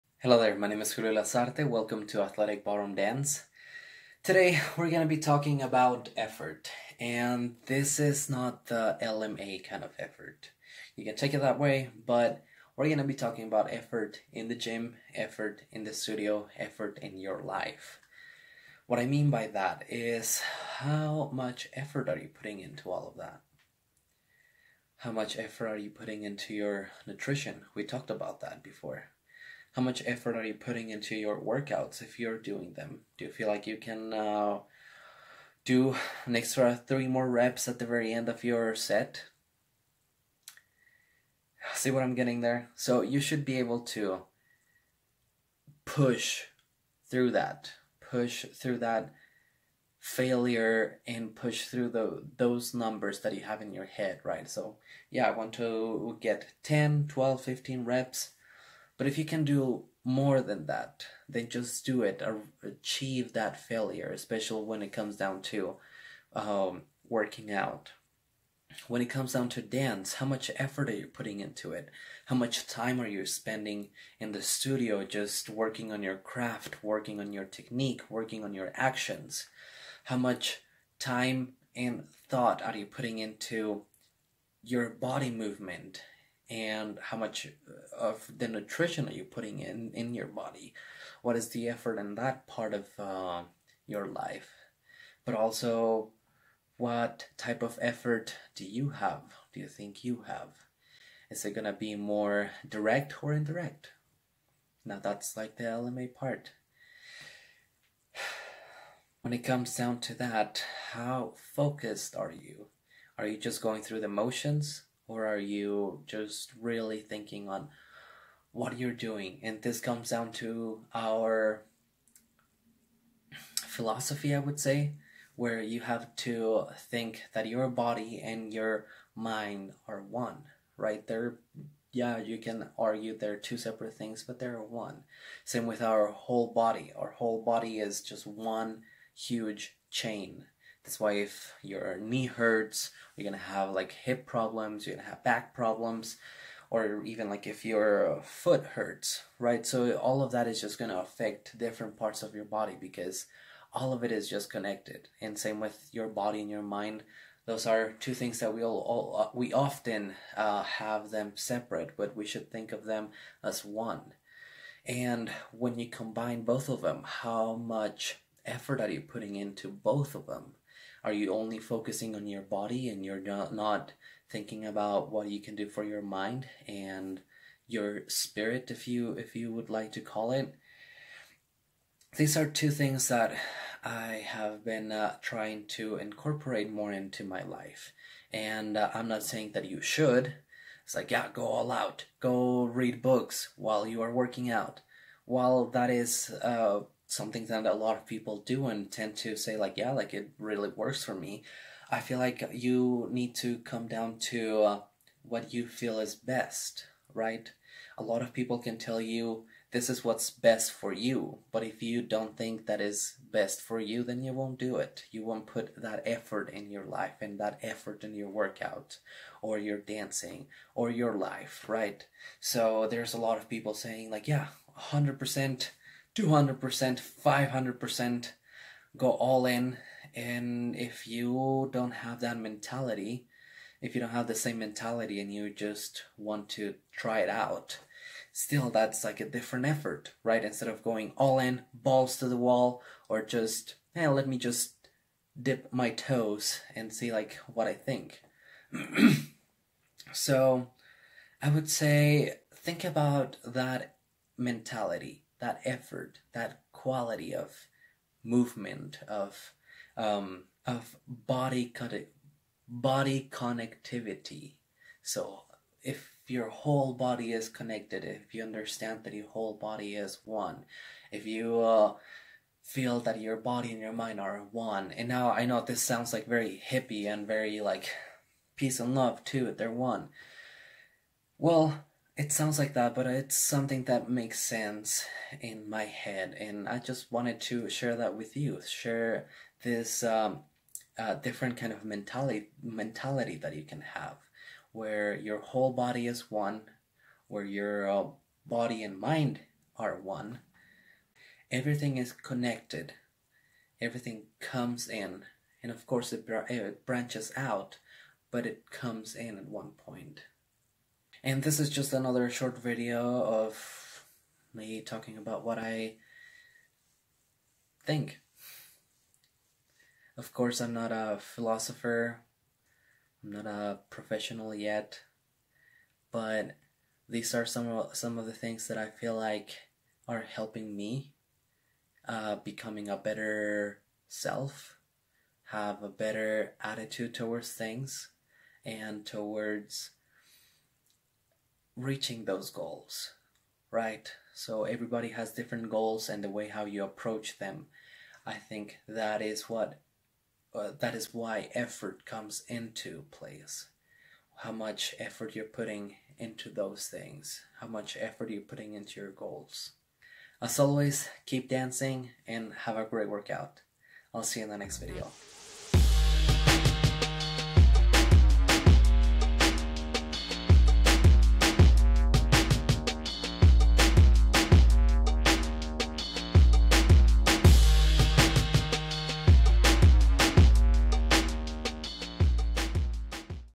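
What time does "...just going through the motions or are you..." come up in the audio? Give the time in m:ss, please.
1:53.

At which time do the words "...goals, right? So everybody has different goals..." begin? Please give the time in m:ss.
5:42.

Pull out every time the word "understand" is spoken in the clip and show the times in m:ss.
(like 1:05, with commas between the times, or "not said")
4:28.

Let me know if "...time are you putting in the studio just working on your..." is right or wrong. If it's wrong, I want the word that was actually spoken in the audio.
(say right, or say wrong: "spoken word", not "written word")
wrong: "spending", not "putting".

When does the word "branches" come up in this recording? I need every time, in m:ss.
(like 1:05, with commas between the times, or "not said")
5:06.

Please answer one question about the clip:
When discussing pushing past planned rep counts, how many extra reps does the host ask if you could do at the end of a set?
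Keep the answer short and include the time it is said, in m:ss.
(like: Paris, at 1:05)
3, at 0:36.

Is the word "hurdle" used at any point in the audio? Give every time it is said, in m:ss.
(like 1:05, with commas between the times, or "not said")
not said.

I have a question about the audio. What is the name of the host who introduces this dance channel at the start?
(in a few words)
Julio Lazarte.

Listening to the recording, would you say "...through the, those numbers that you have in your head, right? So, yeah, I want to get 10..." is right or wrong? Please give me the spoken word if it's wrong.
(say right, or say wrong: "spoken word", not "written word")
right.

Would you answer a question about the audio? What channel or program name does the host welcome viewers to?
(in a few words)
Athletic Ballroom Dance.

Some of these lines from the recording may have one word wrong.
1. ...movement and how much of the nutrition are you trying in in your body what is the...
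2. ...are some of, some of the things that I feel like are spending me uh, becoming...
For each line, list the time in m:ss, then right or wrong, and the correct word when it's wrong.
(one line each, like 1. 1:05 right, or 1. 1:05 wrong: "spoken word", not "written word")
1. 1:25 wrong: "putting", not "trying"
2. 5:27 wrong: "helping", not "spending".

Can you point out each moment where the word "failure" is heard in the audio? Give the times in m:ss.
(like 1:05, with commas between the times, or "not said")
0:49, 1:03.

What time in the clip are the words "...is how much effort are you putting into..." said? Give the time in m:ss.
0:19.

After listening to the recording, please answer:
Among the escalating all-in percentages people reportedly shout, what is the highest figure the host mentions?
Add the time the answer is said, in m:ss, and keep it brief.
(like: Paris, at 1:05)
500%, at 3:46.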